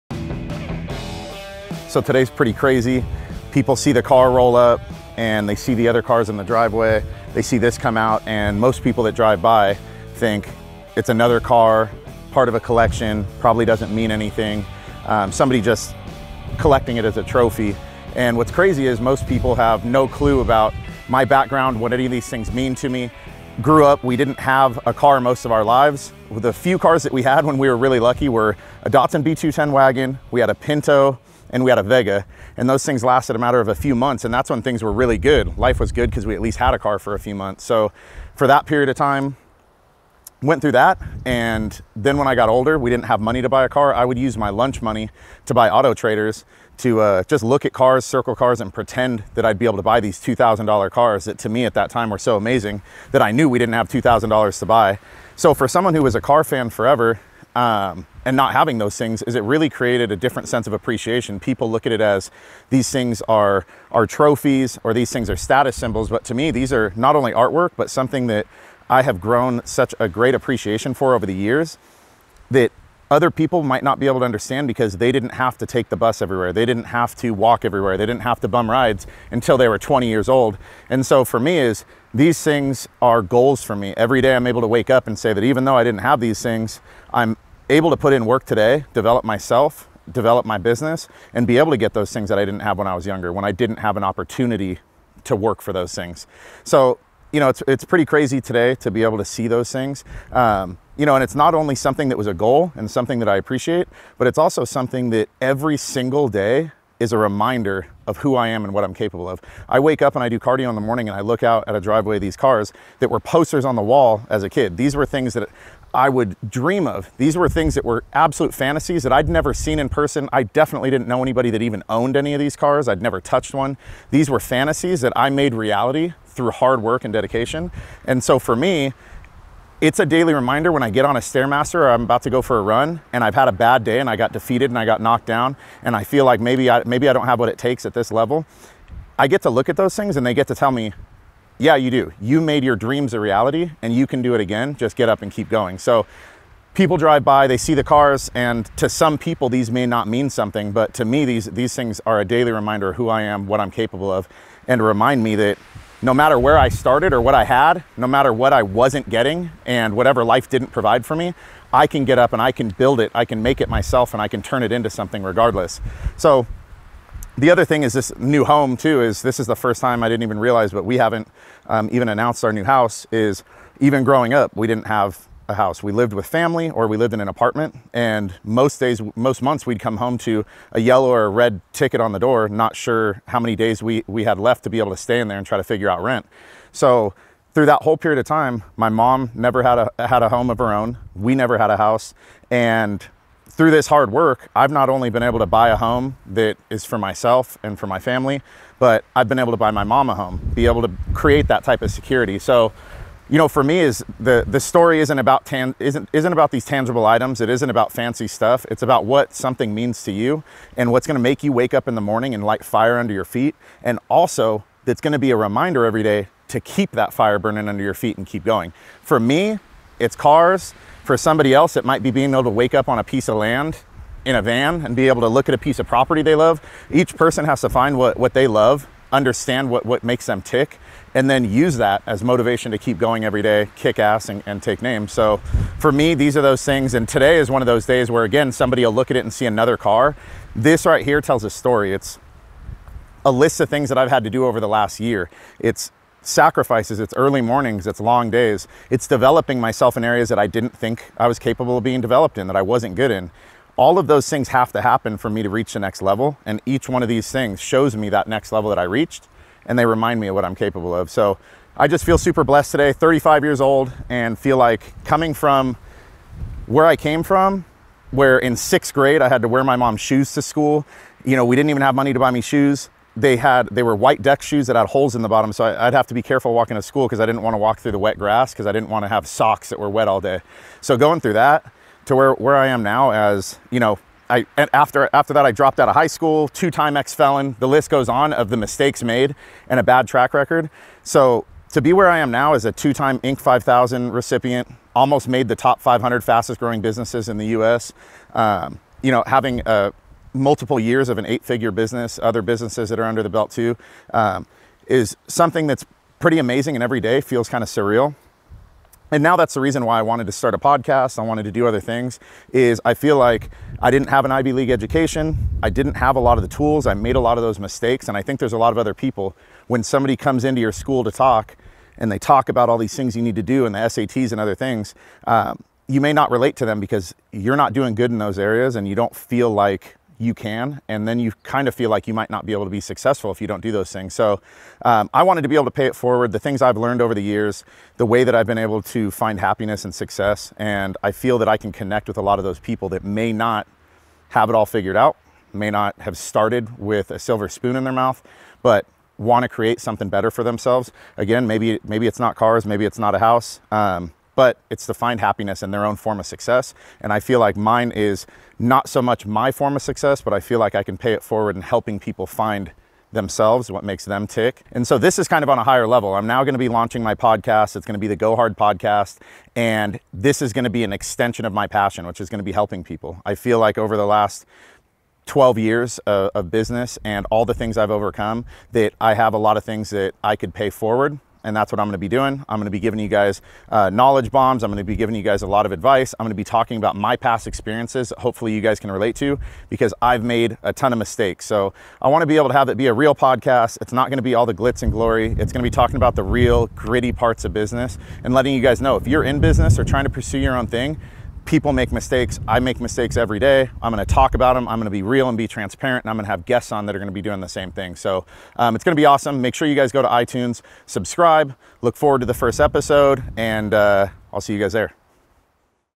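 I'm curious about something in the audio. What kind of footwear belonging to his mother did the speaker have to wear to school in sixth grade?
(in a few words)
white deck shoes.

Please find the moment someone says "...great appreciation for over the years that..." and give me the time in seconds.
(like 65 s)
70 s.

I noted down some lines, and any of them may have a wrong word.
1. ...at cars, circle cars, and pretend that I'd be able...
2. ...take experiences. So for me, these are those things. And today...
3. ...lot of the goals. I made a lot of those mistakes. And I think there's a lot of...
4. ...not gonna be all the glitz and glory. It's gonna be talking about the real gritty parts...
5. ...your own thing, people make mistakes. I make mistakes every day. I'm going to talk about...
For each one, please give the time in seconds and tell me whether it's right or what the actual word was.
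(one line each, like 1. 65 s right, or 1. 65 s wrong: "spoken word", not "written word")
1. 47 s right
2. 234 s wrong: "names", not "experiences"
3. 316 s wrong: "tools", not "goals"
4. 393 s right
5. 400 s right.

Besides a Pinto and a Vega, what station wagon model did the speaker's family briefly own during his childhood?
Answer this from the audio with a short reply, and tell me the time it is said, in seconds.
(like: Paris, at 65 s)
Datsun B210, at 28 s.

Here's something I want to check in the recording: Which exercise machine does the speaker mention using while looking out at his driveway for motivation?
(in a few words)
Stairmaster.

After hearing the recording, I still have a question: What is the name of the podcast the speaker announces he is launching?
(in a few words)
Go Hard podcast.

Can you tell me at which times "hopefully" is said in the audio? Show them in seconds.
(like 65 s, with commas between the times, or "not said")
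388 s.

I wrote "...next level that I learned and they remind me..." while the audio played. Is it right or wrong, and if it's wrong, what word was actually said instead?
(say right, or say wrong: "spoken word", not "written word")
wrong: "reached", not "learned".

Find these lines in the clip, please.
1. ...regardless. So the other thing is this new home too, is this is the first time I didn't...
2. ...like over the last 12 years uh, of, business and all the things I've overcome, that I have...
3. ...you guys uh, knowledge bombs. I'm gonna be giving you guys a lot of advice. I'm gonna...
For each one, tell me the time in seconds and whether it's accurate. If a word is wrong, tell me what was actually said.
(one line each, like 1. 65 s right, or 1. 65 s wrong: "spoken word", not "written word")
1. 165 s right
2. 373 s right
3. 382 s right.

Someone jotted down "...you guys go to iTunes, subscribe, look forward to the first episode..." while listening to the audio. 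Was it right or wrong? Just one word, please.
right.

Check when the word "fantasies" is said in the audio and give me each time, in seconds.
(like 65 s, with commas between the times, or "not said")
118 s, 124 s.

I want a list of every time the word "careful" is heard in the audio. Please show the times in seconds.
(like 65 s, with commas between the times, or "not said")
276 s.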